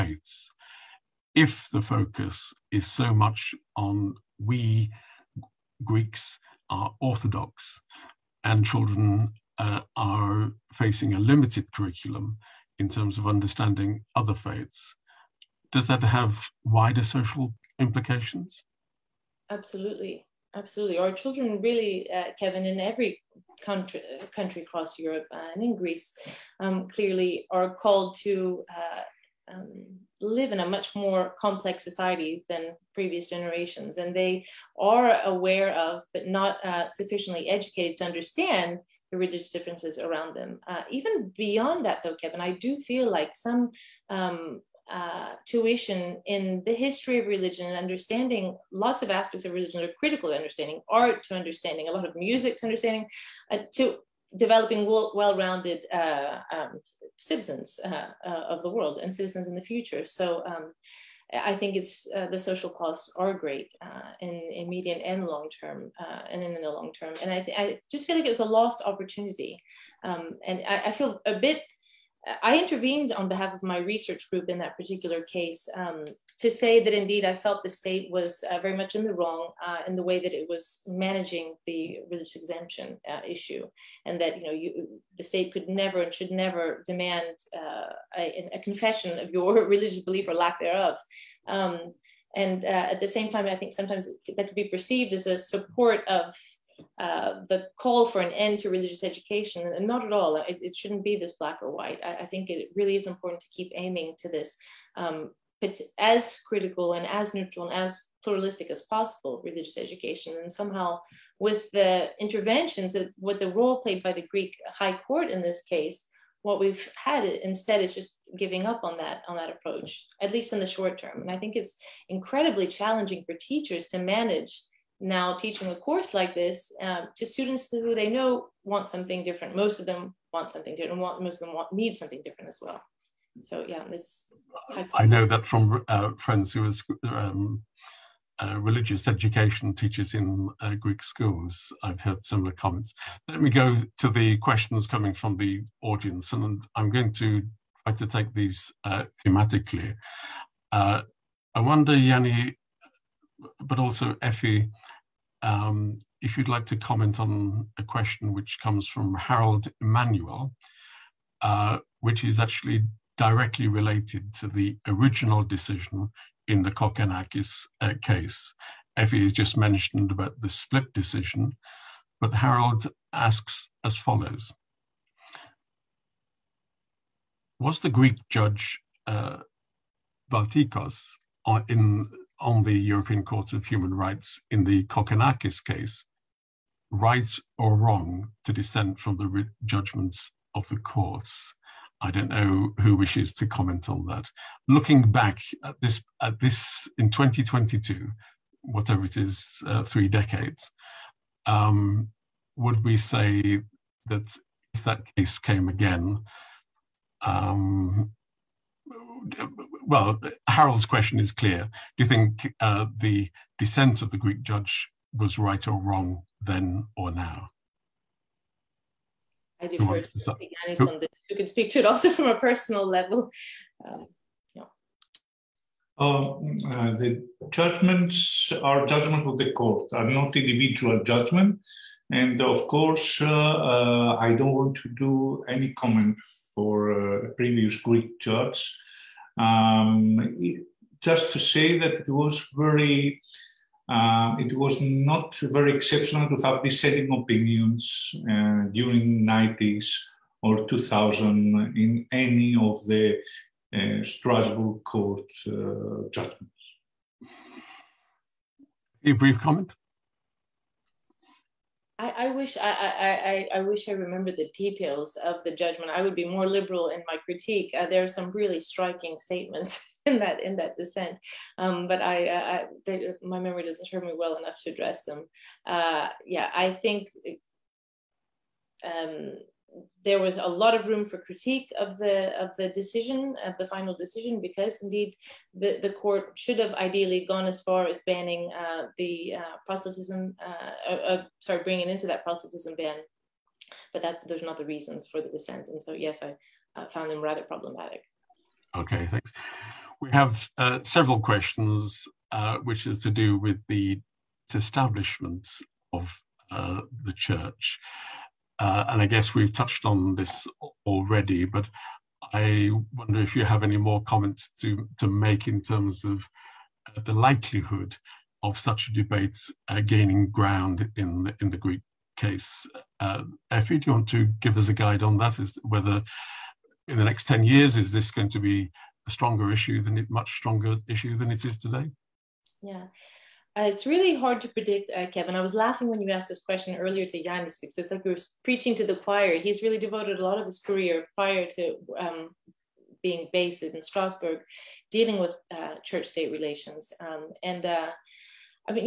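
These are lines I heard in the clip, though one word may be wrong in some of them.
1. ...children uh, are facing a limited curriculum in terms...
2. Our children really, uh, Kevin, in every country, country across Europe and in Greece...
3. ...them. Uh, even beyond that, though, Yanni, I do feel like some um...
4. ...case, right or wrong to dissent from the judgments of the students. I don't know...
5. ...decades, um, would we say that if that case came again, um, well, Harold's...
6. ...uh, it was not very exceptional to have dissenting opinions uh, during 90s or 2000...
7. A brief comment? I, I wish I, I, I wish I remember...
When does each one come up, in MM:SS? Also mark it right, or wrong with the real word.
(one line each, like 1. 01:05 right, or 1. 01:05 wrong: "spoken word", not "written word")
1. 00:08 right
2. 00:20 right
3. 00:40 wrong: "Kevin", not "Yanni"
4. 03:05 wrong: "courts", not "students"
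5. 03:20 right
6. 04:03 right
7. 04:19 right.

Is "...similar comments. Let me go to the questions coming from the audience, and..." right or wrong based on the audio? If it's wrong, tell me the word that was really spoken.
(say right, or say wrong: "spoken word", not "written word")
right.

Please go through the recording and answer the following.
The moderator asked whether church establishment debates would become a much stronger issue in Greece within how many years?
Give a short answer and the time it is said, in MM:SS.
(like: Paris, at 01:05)
10 years, at 05:27.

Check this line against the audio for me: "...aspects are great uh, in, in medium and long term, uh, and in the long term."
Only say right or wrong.
wrong.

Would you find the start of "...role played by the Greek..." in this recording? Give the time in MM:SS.
01:53.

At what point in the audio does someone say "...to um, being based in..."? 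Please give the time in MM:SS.
05:41.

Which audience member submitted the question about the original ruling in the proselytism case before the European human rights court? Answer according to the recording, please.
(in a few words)
Harold Emanuel.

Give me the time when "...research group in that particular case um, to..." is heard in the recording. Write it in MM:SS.
01:13.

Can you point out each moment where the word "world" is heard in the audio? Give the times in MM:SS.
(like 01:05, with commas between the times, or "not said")
00:58.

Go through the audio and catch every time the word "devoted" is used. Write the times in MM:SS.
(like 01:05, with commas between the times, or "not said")
05:39.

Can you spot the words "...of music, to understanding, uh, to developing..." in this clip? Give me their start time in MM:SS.
00:52.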